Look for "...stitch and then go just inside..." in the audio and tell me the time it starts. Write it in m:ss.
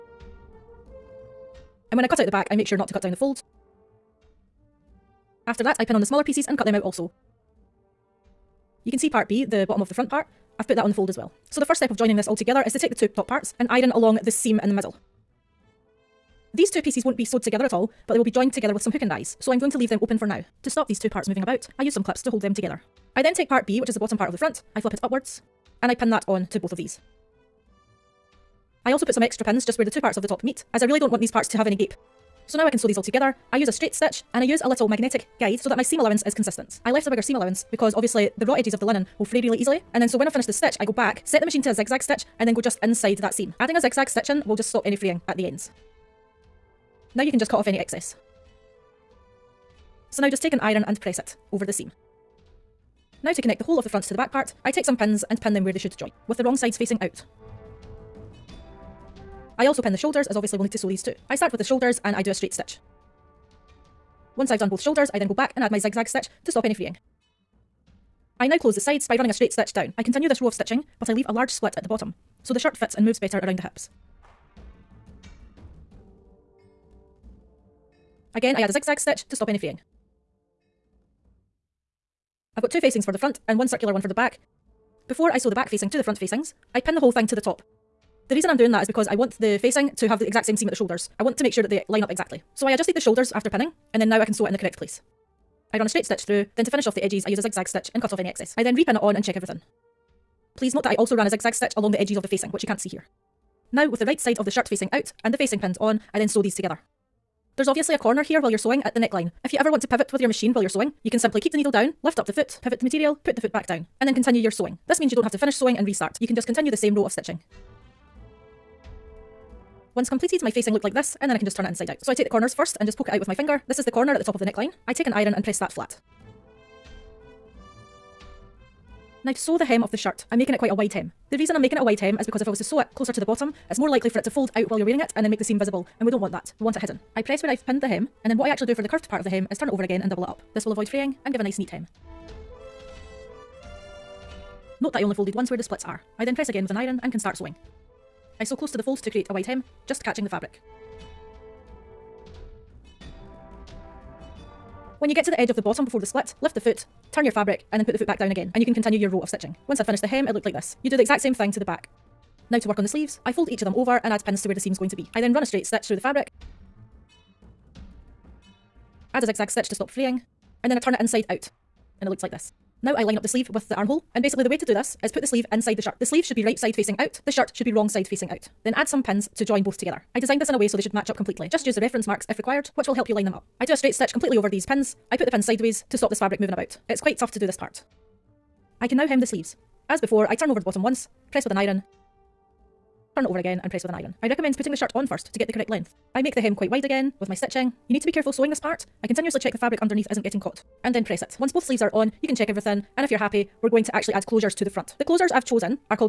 0:42.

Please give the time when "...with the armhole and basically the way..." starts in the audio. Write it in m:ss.
2:53.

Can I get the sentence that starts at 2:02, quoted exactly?
So I take the corners first and just poke it out with my finger.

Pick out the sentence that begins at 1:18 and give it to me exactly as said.
Again, I add a zigzag stitch to stop any fraying.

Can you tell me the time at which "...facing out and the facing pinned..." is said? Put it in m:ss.
1:44.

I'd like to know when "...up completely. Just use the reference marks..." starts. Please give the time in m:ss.
3:01.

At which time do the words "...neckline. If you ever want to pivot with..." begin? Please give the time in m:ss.
1:48.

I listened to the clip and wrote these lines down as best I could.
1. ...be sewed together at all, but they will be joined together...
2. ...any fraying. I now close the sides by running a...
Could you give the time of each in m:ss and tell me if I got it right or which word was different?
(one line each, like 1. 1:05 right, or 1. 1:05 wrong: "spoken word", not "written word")
1. 0:17 right
2. 1:06 right.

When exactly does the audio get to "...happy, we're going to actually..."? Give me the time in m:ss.
3:23.